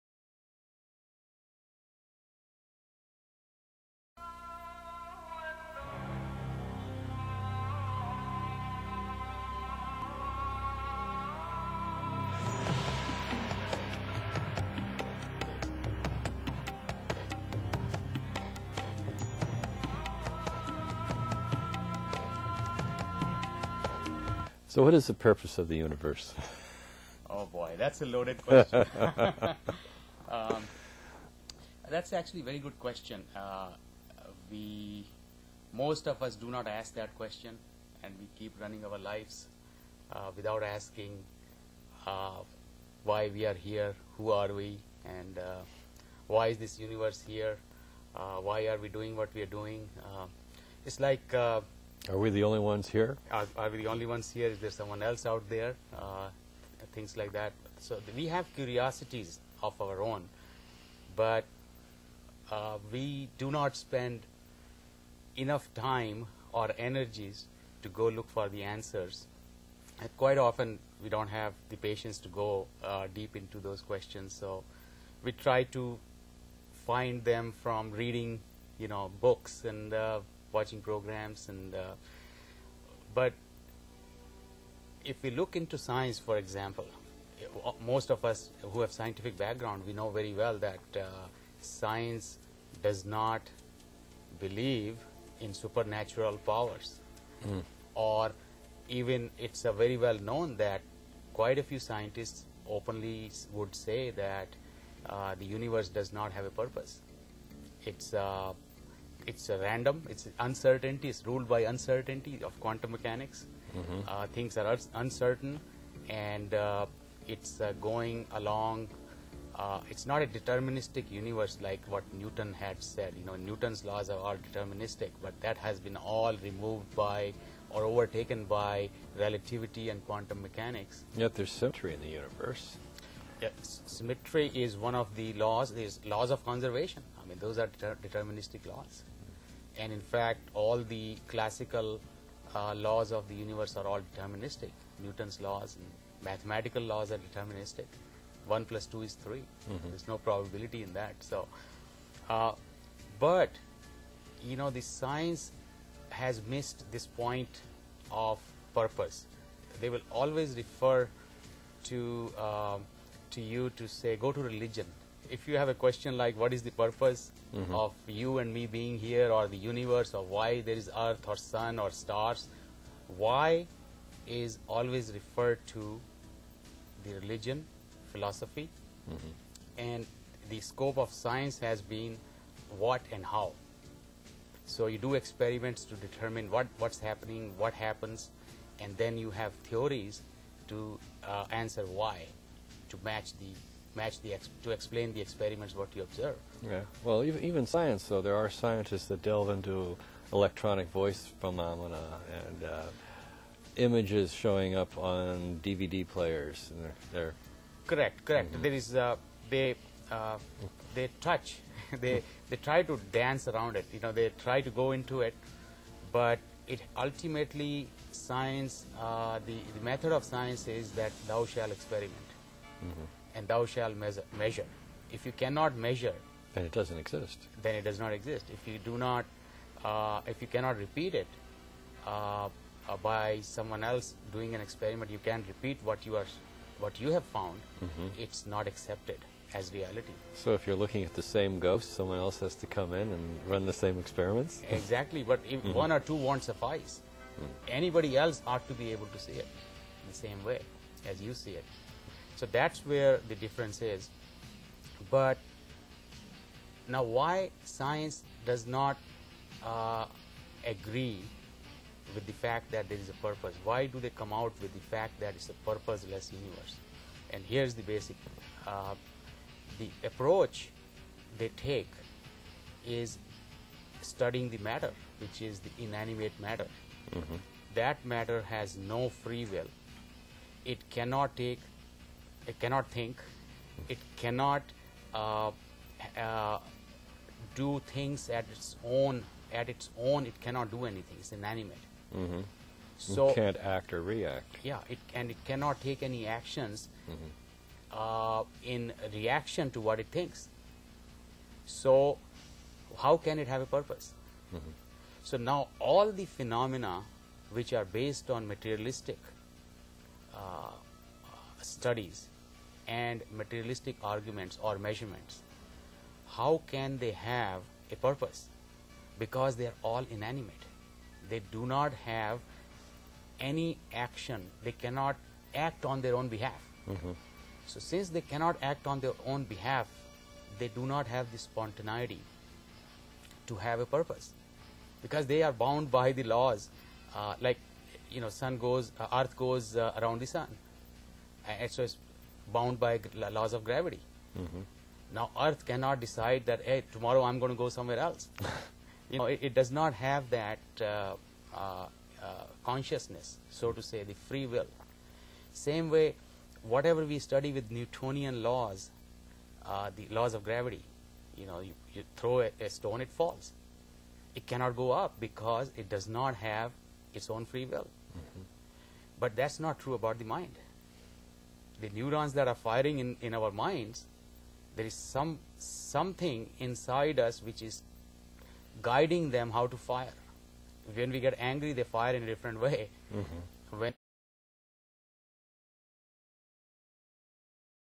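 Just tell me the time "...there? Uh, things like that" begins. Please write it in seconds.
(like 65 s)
55 s.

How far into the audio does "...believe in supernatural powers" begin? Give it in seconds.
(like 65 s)
94 s.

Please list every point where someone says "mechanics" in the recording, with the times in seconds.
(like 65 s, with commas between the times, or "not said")
112 s, 130 s.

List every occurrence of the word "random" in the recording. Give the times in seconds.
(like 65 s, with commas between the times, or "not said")
109 s.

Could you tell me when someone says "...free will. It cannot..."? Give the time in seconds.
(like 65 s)
279 s.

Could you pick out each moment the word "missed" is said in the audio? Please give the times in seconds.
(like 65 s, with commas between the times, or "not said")
156 s.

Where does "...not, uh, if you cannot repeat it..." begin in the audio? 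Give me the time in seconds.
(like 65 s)
228 s.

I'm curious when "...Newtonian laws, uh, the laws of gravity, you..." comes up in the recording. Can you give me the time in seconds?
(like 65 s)
357 s.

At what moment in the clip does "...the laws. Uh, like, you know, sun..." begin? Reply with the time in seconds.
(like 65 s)
336 s.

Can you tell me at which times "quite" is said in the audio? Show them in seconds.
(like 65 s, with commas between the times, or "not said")
70 s, 101 s.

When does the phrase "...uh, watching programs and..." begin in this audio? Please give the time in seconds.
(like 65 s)
79 s.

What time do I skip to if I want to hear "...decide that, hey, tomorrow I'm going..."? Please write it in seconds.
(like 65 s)
345 s.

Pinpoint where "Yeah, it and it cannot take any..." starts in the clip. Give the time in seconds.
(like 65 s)
294 s.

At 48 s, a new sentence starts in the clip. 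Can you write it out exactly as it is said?
Uh, why are we doing what we are doing?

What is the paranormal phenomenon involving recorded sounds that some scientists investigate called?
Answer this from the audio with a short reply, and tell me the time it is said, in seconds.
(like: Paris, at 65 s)
electronic voice phenomena, at 200 s.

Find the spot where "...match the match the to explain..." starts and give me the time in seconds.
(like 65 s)
193 s.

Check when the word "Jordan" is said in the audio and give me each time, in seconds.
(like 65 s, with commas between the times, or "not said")
not said.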